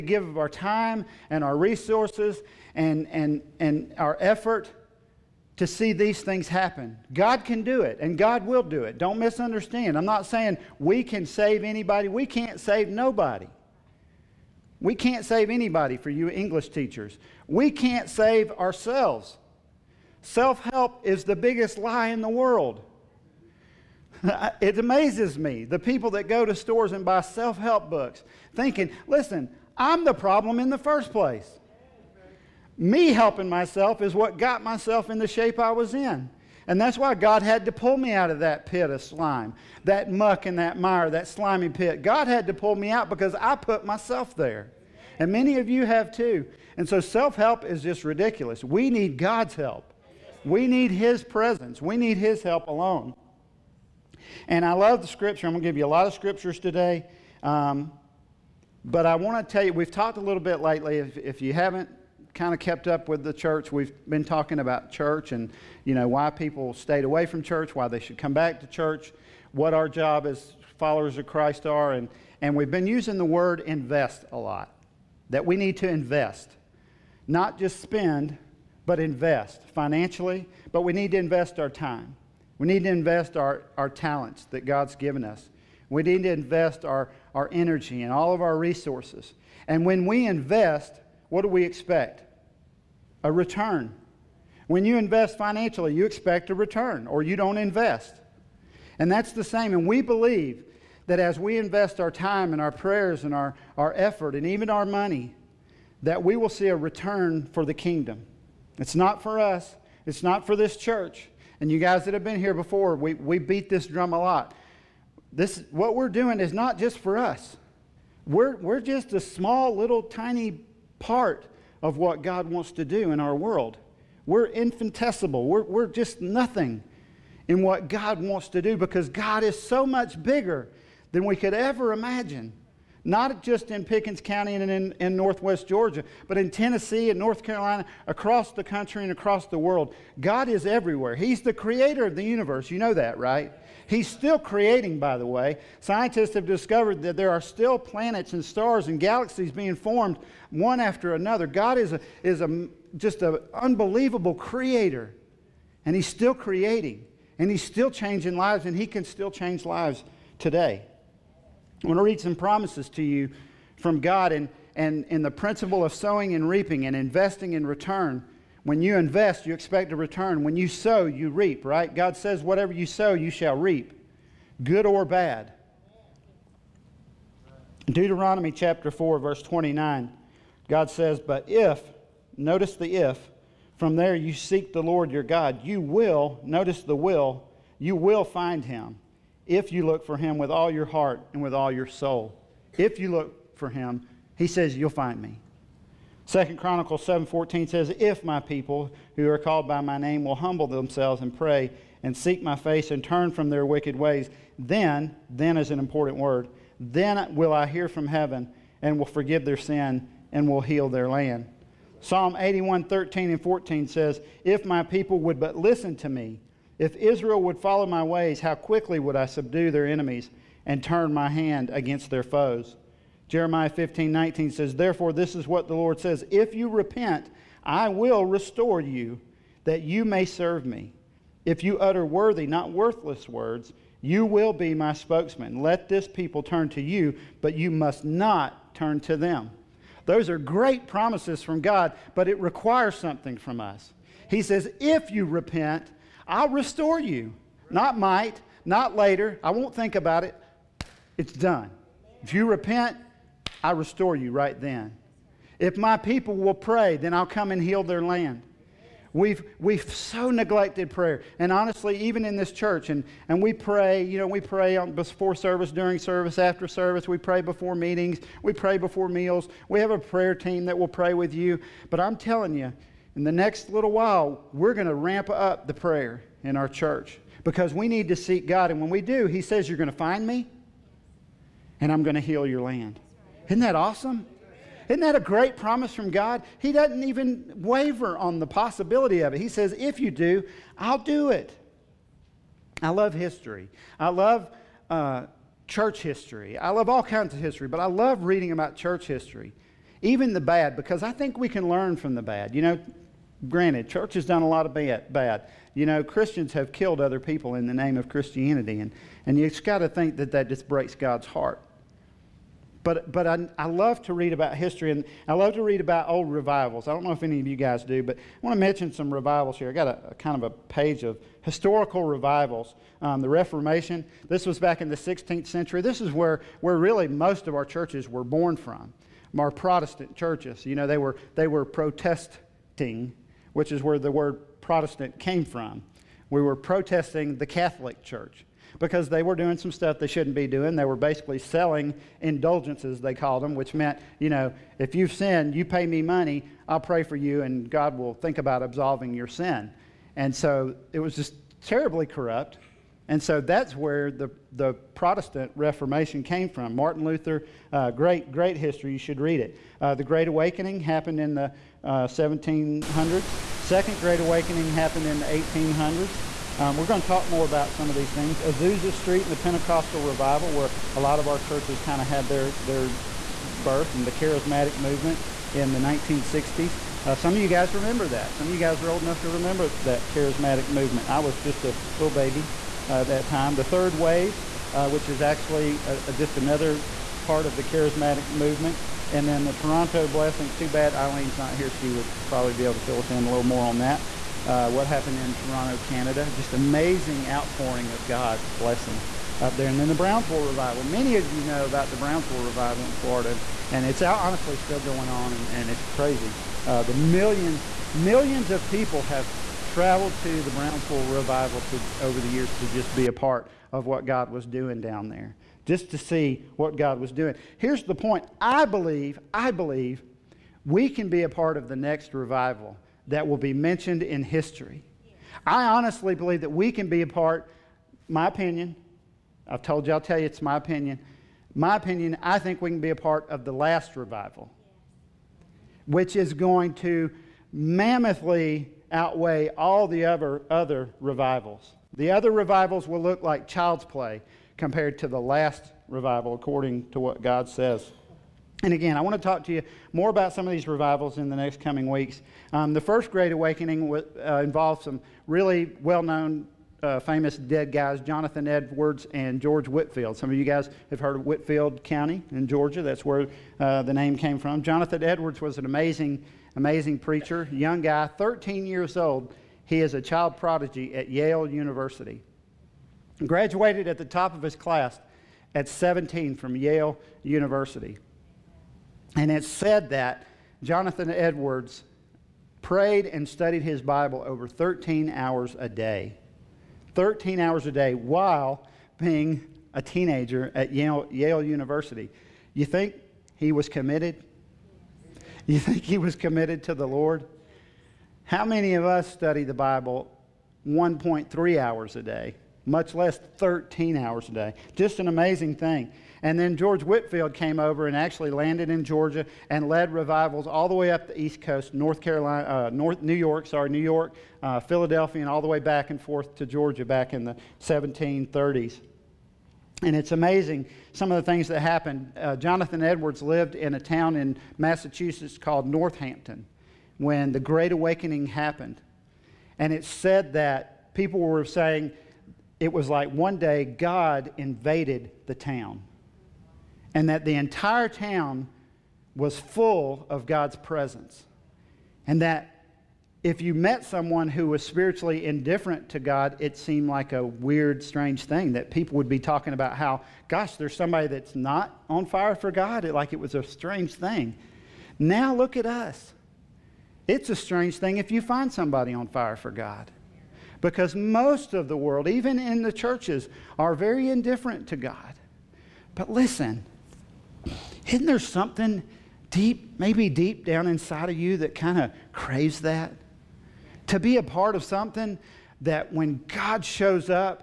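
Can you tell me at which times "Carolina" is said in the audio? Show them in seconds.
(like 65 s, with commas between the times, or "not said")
137 s, 512 s.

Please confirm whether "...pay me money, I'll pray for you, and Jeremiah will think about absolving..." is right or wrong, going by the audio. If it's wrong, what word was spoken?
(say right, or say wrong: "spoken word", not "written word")
wrong: "God", not "Jeremiah".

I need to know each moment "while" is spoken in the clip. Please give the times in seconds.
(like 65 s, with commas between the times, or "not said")
273 s, 487 s.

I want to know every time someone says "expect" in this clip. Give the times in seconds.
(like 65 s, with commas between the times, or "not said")
91 s, 96 s, 169 s.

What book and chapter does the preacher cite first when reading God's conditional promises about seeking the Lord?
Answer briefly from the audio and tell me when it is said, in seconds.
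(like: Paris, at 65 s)
Deuteronomy 4, at 177 s.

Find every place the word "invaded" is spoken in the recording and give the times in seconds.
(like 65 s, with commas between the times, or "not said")
534 s.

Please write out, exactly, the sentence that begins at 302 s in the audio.
You know, granted, church has done a lot of bad.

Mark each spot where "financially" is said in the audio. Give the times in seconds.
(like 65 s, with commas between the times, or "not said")
79 s, 95 s.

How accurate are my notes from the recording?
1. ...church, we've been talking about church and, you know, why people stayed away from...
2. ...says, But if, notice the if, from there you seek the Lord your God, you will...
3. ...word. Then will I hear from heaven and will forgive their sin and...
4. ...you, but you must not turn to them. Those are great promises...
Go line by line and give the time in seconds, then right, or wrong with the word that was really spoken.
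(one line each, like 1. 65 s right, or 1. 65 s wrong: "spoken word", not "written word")
1. 63 s right
2. 180 s right
3. 206 s right
4. 236 s right.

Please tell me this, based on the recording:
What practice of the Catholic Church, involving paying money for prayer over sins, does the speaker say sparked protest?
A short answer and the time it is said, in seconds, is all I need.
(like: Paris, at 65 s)
Selling indulgences, at 341 s.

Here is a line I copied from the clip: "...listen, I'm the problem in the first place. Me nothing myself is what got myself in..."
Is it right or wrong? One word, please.
wrong.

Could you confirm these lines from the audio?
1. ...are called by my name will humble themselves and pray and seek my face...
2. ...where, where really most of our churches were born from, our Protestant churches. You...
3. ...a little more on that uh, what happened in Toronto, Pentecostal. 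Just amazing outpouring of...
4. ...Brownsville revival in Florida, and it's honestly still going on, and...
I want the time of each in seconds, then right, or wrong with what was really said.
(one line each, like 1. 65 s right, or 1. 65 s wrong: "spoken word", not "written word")
1. 199 s right
2. 326 s right
3. 393 s wrong: "Canada", not "Pentecostal"
4. 401 s right.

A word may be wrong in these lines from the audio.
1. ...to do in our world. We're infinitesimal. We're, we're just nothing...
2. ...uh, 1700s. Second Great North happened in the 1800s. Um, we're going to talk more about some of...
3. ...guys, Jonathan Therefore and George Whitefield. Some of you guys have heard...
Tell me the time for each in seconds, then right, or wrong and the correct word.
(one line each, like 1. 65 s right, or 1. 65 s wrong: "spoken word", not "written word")
1. 122 s right
2. 361 s wrong: "Awakening", not "North"
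3. 457 s wrong: "Edwards", not "Therefore".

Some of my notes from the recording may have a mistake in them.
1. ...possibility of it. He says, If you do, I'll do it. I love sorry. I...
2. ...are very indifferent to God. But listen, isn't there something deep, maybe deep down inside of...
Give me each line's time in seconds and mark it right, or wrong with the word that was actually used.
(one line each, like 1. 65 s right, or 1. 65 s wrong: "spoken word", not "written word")
1. 288 s wrong: "history", not "sorry"
2. 563 s right.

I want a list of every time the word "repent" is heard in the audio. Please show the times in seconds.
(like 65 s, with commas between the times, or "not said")
226 s, 245 s, 252 s.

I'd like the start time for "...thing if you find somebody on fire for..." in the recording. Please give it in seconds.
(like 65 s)
557 s.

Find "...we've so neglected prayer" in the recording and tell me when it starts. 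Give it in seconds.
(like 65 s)
259 s.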